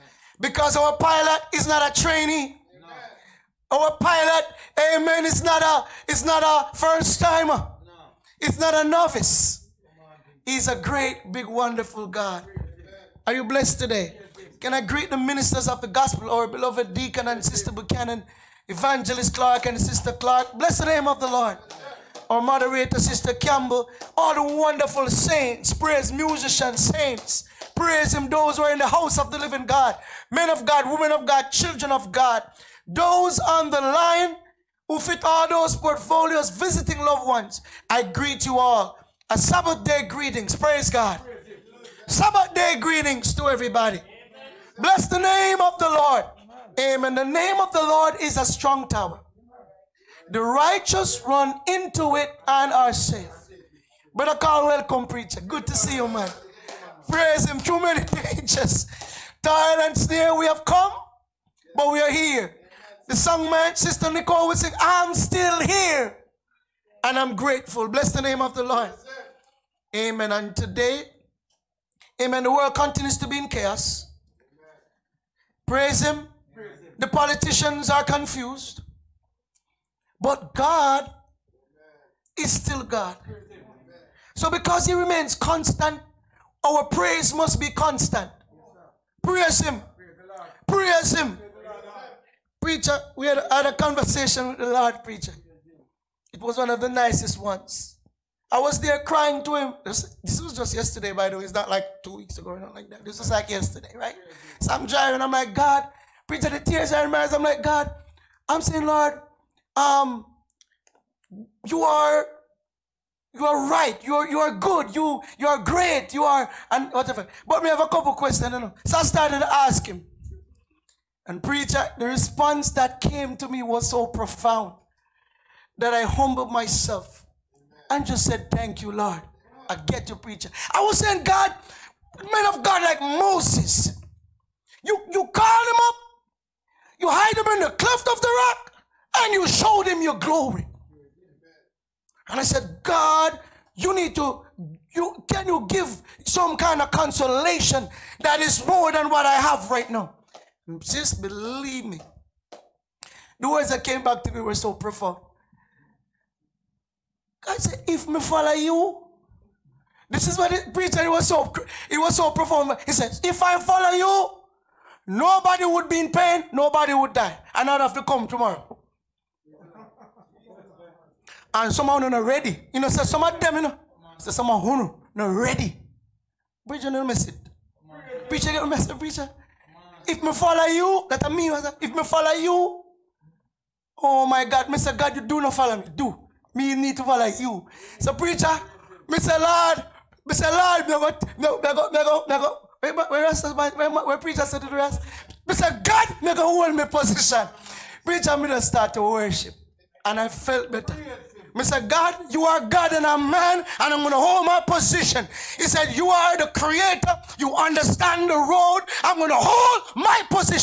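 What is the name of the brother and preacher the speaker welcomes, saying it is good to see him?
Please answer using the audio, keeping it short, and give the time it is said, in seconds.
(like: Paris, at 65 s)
Carl, at 54 s.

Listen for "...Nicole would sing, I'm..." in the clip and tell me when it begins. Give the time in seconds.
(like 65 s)
64 s.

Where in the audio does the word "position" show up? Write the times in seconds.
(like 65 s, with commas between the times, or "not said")
196 s, 204 s.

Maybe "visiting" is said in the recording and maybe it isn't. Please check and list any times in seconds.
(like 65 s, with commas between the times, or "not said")
36 s.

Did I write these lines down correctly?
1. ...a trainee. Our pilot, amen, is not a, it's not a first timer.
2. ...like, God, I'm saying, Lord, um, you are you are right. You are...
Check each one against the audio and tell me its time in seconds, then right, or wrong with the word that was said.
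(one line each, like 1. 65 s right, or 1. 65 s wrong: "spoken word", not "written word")
1. 1 s right
2. 107 s right.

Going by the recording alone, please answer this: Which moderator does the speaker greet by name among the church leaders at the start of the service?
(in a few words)
Sister Campbell.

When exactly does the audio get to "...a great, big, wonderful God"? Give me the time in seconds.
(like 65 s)
10 s.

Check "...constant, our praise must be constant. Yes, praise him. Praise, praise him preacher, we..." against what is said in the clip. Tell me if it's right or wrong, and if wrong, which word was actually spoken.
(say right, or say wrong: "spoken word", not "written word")
right.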